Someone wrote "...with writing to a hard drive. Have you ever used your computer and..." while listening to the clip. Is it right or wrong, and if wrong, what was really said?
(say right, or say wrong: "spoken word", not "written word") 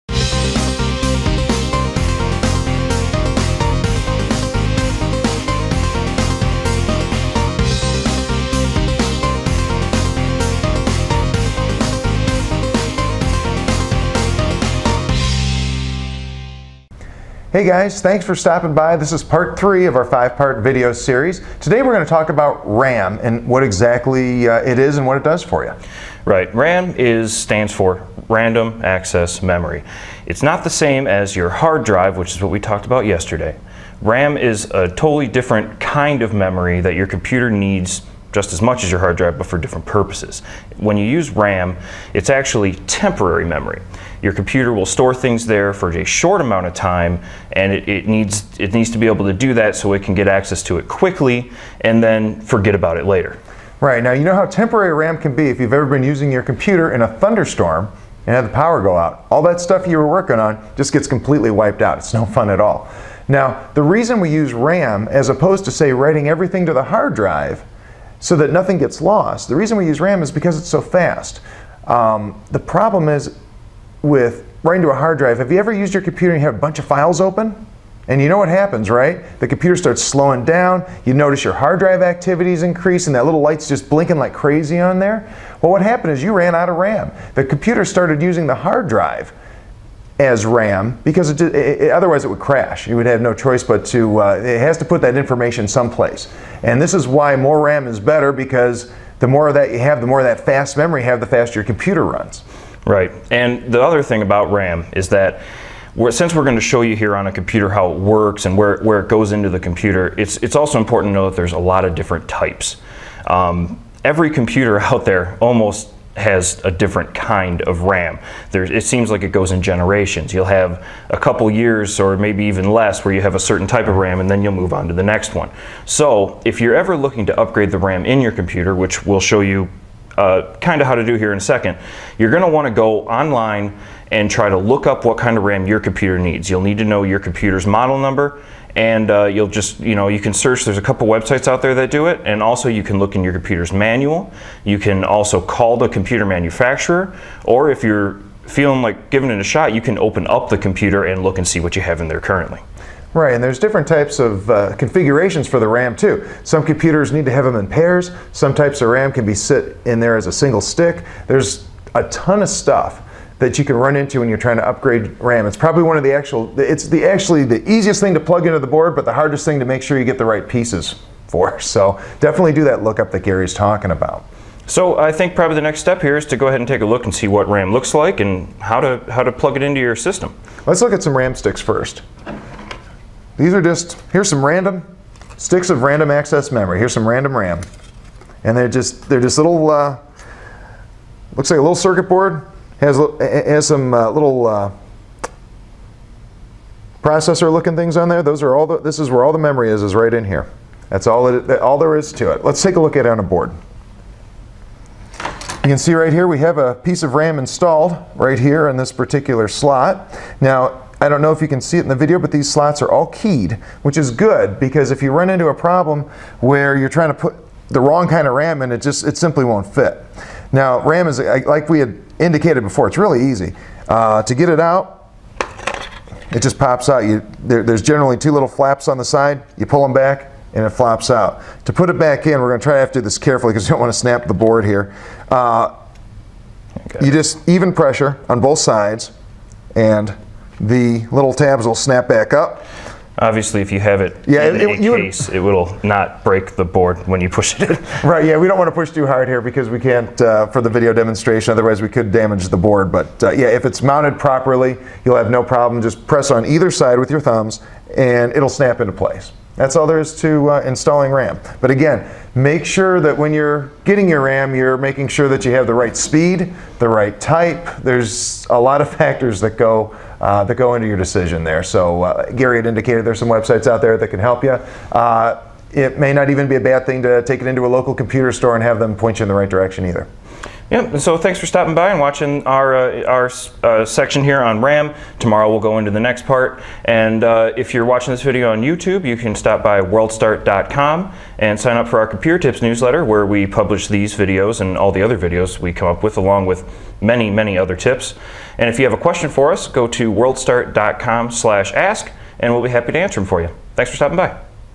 right.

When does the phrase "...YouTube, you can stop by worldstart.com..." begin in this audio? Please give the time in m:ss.
4:48.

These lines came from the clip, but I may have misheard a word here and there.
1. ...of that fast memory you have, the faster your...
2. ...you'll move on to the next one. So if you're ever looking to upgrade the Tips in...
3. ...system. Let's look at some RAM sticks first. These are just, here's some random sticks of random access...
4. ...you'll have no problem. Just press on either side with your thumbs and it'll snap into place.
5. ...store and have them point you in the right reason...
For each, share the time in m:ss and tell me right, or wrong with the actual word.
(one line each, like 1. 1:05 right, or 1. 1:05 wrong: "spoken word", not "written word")
1. 1:40 right
2. 2:04 wrong: "RAM", not "Tips"
3. 2:59 right
4. 4:15 right
5. 4:38 wrong: "direction", not "reason".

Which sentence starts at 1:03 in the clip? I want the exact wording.
Now, the reason we use RAM as opposed to, say, writing everything to the hard drive so that nothing gets lost.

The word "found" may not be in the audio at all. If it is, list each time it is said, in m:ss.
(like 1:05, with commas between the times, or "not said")
not said.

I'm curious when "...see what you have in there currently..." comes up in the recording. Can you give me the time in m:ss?
2:31.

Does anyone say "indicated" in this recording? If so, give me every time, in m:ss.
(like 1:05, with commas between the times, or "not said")
3:42, 4:32.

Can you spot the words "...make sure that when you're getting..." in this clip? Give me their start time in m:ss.
4:22.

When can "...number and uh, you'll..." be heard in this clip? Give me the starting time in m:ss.
2:17.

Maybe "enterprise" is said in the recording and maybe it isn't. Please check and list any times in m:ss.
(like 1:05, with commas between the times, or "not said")
not said.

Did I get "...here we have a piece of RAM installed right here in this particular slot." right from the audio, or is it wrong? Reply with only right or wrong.
right.